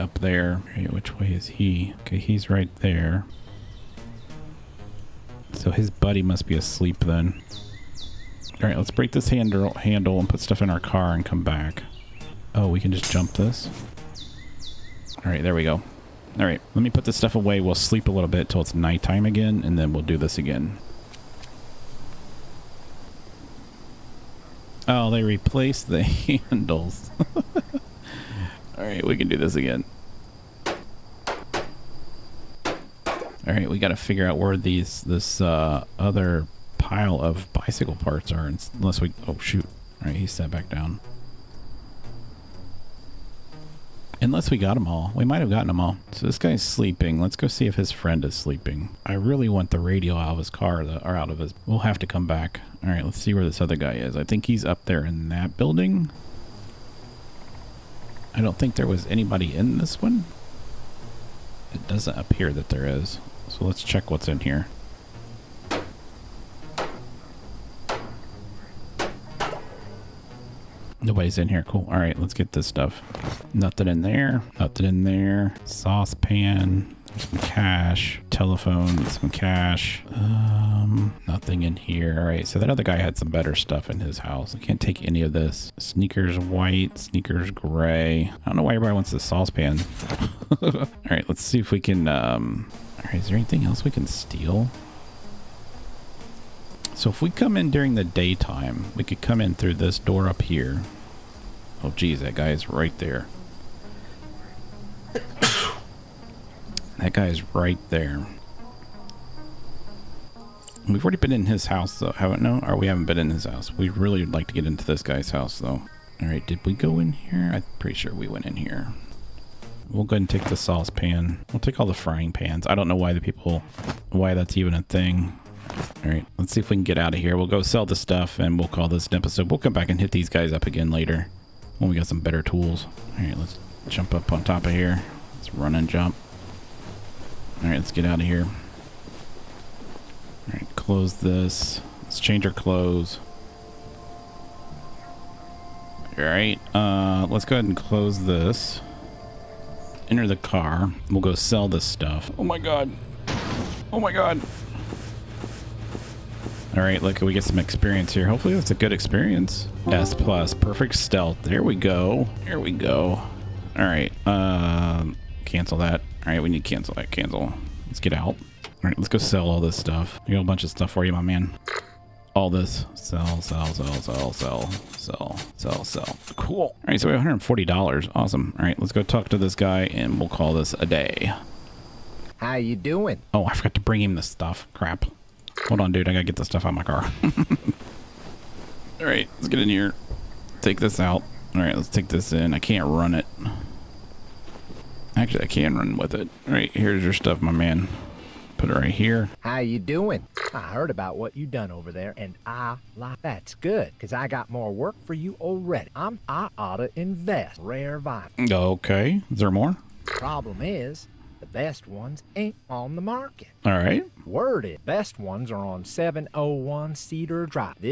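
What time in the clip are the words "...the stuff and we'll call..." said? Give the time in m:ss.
2:07.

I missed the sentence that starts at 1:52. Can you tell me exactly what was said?
No, or we haven't been in his house.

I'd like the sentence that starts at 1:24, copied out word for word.
I can't take any of this.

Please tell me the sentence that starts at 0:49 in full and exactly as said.
I really want the radio out of his car, or out of his...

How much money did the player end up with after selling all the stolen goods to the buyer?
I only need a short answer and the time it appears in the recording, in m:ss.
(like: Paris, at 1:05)
$140, at 2:57.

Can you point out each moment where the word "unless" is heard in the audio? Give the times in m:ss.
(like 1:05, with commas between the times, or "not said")
0:38, 0:44.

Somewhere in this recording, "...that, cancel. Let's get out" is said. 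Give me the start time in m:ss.
2:46.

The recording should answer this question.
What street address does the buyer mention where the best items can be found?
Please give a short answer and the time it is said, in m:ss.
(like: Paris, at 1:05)
701 Cedar, at 3:35.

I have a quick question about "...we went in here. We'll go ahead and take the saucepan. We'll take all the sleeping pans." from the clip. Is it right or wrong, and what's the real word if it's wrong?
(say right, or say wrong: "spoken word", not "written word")
wrong: "frying", not "sleeping".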